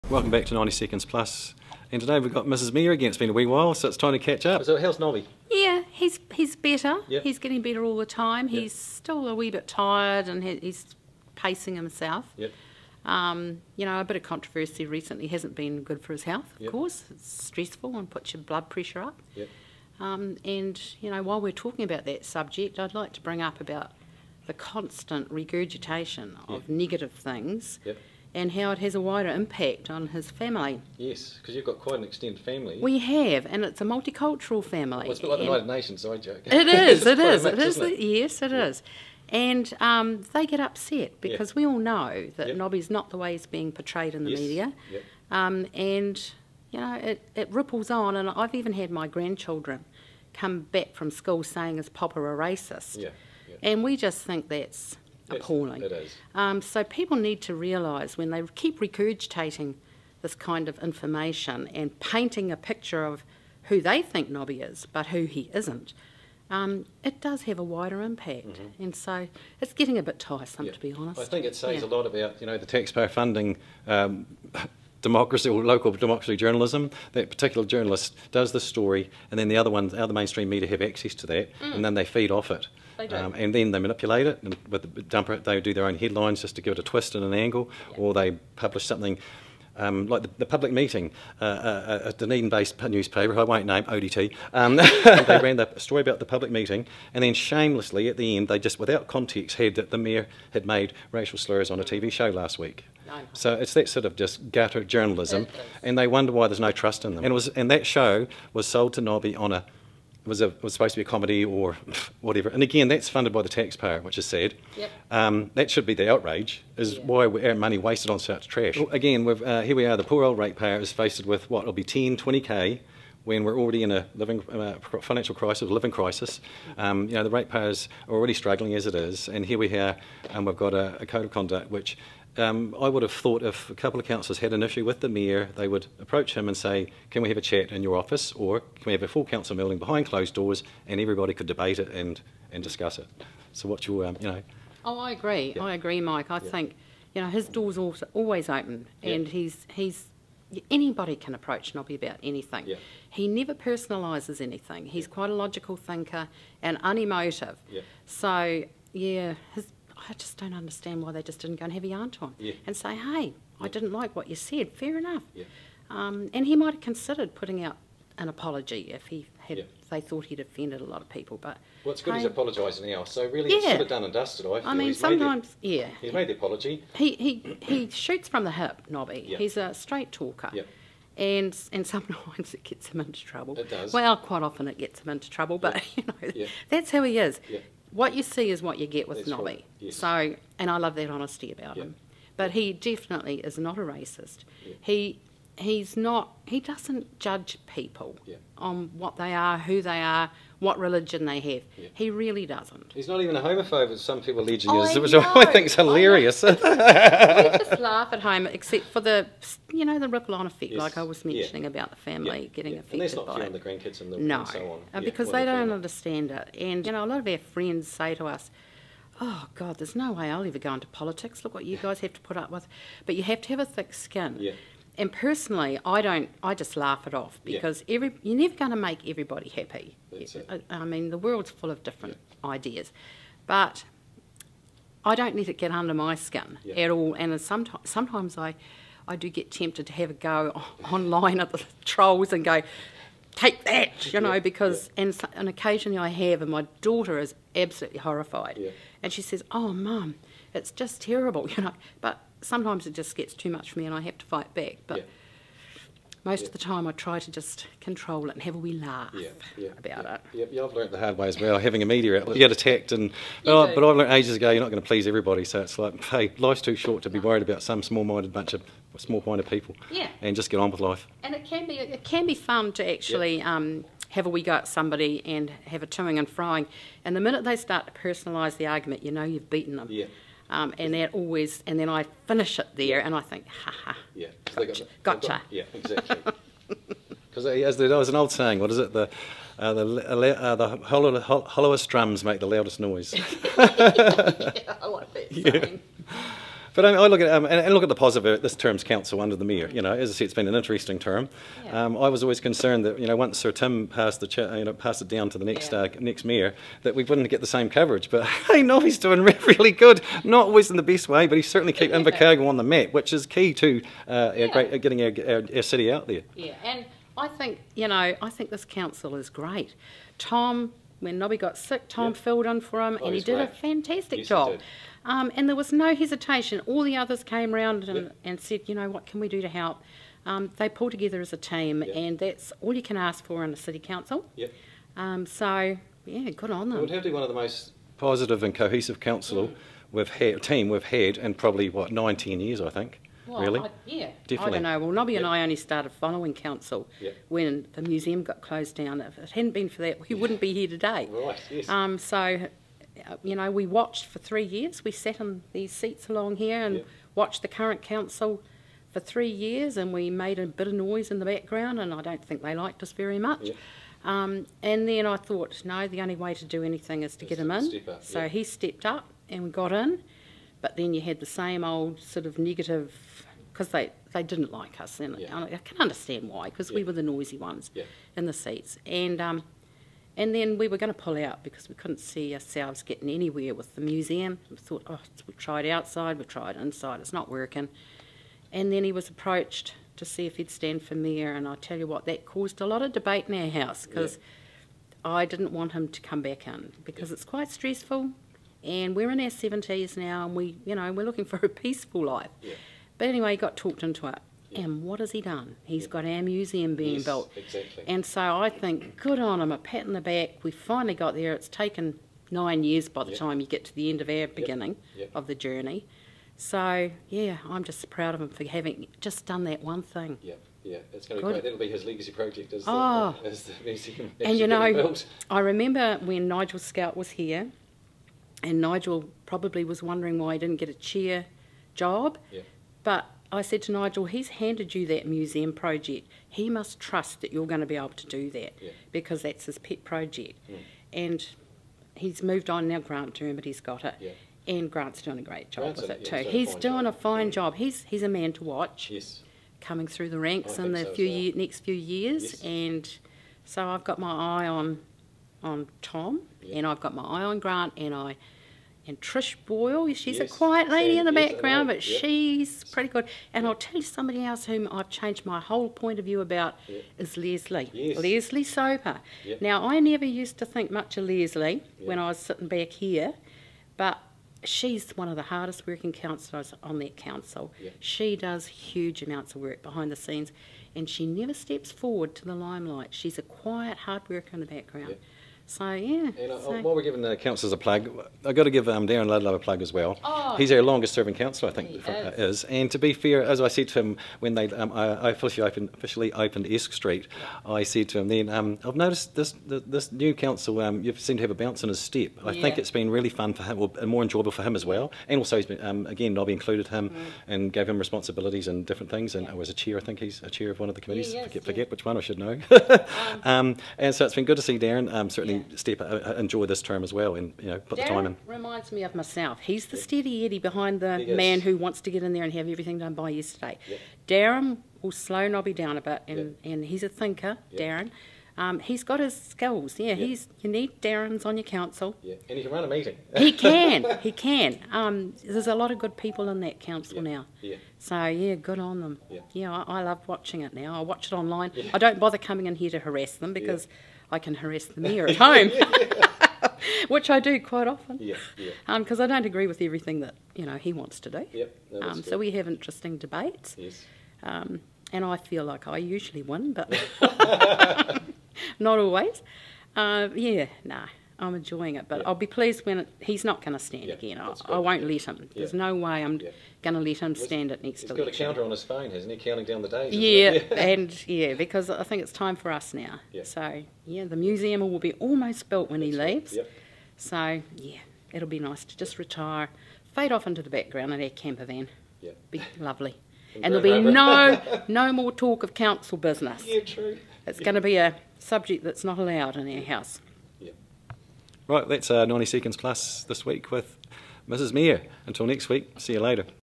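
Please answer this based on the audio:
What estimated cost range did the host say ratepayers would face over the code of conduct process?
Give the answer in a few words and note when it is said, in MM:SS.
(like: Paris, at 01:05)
10 to 20k, at 02:01.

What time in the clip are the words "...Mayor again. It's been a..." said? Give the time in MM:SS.
00:02.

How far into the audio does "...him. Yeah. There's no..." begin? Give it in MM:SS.
09:25.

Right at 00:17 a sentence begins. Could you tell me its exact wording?
It's stressful and puts your blood pressure up.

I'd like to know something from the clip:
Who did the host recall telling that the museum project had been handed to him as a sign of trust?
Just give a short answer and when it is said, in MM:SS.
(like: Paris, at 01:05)
Nigel Skelt, at 07:06.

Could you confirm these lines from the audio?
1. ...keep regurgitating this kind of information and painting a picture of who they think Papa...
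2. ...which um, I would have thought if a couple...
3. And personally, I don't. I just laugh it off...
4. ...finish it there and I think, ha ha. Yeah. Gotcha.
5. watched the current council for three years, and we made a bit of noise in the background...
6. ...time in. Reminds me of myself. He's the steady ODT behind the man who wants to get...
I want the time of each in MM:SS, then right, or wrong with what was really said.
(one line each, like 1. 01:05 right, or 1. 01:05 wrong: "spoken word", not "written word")
1. 00:58 wrong: "Nobby", not "Papa"
2. 02:11 right
3. 03:45 right
4. 04:42 right
5. 05:57 right
6. 08:37 wrong: "Eddie", not "ODT".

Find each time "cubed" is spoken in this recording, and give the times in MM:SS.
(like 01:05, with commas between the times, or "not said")
not said.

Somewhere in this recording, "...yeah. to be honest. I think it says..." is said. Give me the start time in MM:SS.
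01:10.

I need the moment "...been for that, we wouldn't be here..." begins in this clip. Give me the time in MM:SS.
05:49.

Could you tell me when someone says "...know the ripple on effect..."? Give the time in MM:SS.
03:29.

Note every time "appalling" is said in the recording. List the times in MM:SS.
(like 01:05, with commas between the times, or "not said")
00:55.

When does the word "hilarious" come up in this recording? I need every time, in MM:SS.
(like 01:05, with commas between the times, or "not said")
03:25.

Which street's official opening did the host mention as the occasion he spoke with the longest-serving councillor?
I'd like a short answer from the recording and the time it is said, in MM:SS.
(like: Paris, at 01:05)
Esk Street, at 08:16.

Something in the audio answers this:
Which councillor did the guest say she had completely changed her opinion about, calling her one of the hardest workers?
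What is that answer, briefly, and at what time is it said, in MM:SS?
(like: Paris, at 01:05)
Lesley Soper, at 07:47.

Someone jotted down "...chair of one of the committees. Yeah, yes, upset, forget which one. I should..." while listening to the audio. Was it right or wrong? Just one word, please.
wrong.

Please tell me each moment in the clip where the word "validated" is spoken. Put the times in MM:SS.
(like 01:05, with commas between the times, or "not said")
not said.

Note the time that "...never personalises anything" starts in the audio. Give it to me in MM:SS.
02:33.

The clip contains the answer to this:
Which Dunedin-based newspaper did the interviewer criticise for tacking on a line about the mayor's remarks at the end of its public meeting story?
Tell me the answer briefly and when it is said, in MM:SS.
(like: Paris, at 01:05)
ODT, at 01:33.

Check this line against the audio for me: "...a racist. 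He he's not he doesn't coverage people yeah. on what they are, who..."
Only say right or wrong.
wrong.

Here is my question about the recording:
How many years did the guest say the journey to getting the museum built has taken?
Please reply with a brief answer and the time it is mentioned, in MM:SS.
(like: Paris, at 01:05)
9, at 06:52.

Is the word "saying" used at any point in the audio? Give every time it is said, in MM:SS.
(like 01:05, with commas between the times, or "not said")
00:51, 04:48.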